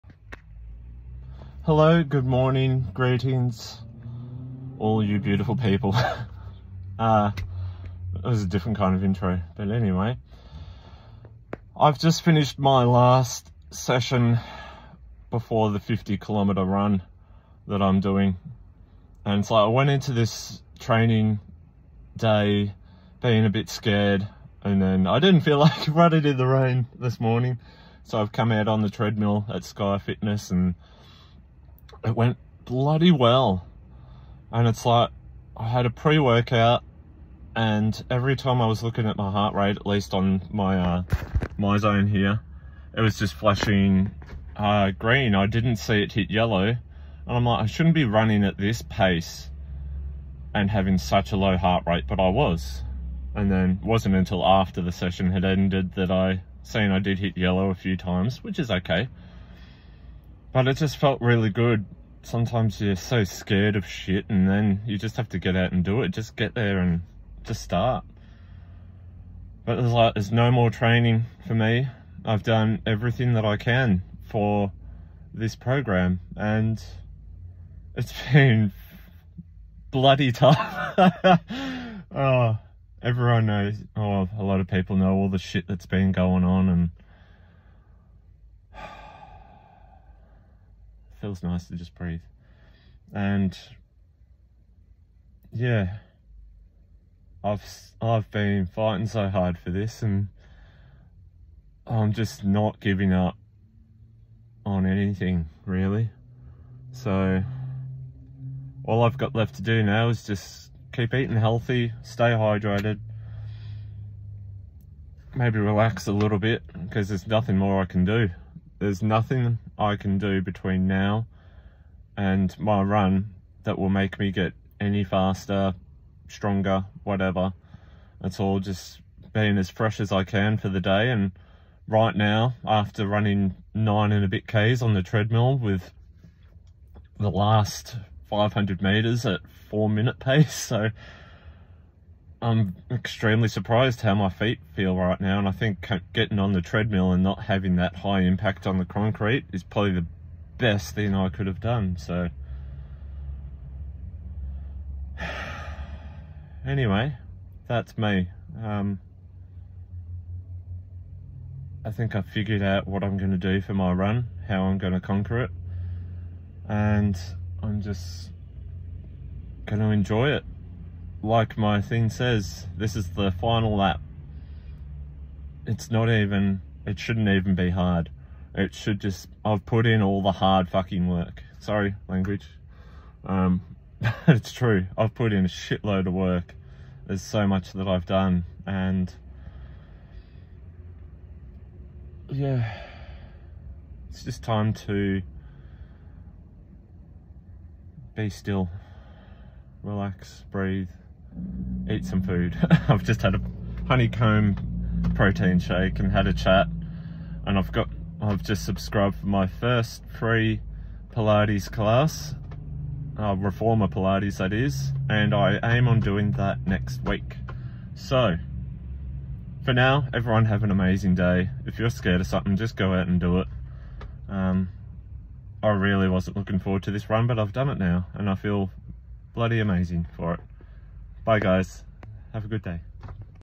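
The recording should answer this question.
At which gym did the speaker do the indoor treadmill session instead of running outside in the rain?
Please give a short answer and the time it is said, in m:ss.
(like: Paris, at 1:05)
Sky Fitness, at 0:29.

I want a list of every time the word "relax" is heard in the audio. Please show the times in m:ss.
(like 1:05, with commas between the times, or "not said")
1:55, 3:19.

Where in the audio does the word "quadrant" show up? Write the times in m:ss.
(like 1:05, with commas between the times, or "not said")
not said.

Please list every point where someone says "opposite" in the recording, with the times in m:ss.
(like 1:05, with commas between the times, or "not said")
not said.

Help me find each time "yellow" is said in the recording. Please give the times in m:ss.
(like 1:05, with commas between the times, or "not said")
0:46, 0:57.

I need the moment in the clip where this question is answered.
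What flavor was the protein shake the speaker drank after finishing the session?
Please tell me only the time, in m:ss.
3:23.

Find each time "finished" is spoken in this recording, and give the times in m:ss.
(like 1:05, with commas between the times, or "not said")
0:12.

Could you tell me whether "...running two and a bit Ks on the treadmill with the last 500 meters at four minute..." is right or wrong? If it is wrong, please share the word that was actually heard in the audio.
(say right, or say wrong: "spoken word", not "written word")
wrong: "nine", not "two".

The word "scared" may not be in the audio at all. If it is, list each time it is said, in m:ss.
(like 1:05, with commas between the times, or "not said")
0:23, 1:03, 3:41.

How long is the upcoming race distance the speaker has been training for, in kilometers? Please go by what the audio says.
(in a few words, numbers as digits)
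50 kilometers.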